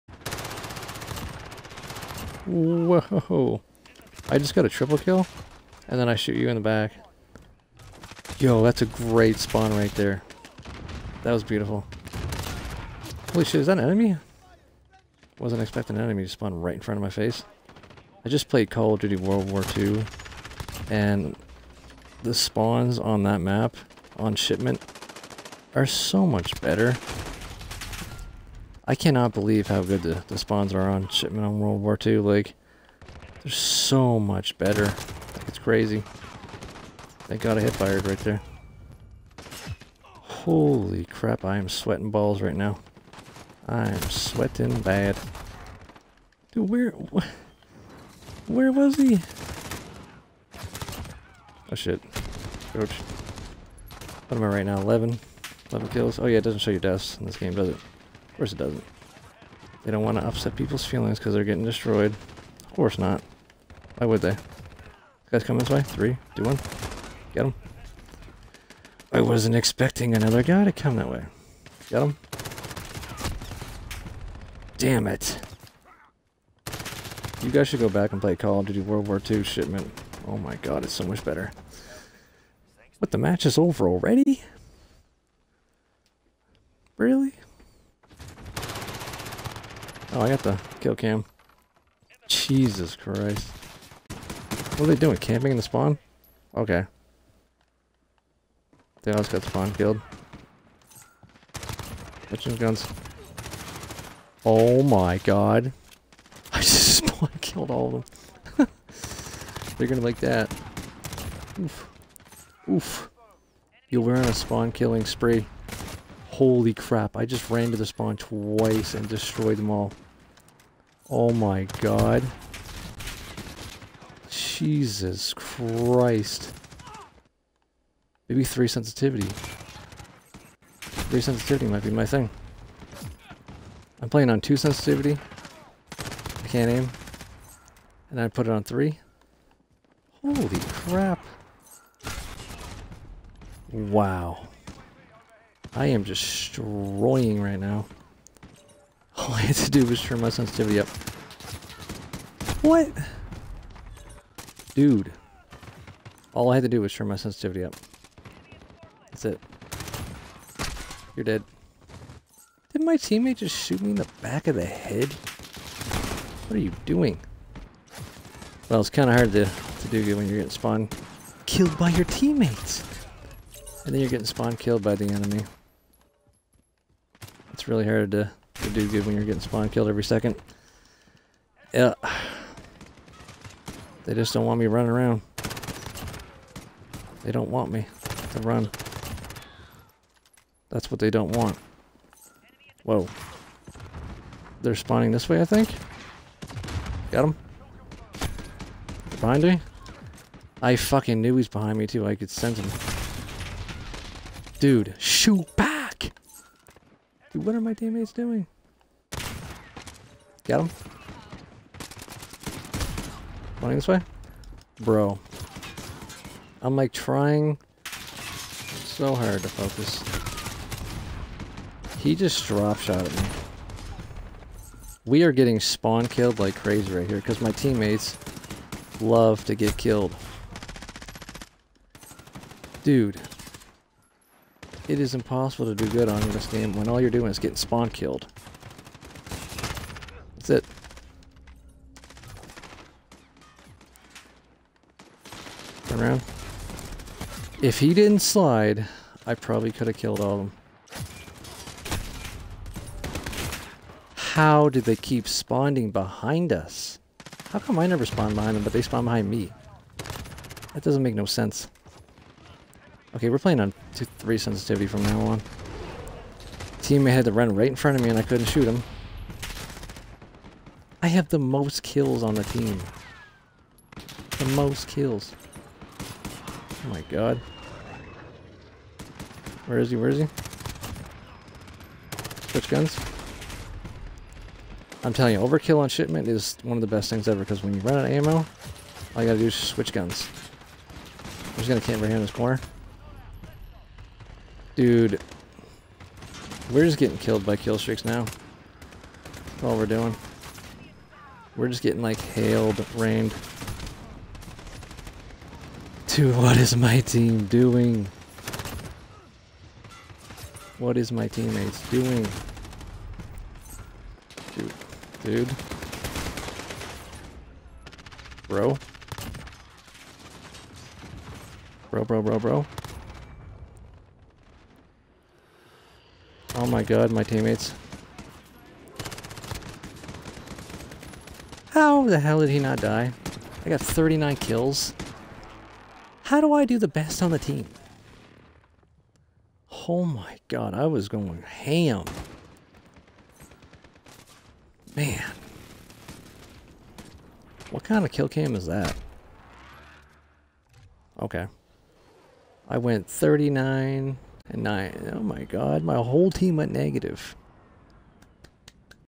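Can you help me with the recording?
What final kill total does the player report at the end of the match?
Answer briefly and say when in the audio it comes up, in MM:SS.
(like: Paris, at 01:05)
39, at 05:33.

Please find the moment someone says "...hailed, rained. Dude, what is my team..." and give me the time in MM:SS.
05:02.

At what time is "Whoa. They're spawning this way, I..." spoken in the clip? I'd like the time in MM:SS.
03:12.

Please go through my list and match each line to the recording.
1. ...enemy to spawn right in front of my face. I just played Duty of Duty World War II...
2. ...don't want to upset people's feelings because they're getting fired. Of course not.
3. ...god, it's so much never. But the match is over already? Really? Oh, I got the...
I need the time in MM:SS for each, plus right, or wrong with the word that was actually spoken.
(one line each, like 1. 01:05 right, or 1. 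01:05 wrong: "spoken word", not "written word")
1. 00:16 wrong: "Call", not "Duty"
2. 00:59 wrong: "destroyed", not "fired"
3. 01:20 wrong: "better", not "never".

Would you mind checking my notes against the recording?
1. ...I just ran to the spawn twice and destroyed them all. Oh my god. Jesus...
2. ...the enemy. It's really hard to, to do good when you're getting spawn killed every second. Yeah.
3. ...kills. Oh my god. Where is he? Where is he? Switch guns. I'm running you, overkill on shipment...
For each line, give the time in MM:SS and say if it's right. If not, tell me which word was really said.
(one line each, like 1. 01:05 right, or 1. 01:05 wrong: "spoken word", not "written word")
1. 01:57 right
2. 02:54 right
3. 04:34 wrong: "telling", not "running".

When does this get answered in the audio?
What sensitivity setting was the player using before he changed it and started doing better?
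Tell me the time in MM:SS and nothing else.
02:14.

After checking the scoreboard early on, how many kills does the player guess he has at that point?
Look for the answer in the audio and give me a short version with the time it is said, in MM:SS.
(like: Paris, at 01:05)
11, at 00:54.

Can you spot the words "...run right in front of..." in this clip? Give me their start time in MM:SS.
04:27.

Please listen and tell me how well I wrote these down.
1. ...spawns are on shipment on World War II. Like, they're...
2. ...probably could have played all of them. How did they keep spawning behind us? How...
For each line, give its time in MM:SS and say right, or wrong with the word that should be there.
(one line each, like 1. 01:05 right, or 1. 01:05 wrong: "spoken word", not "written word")
1. 00:30 right
2. 04:09 wrong: "killed", not "played".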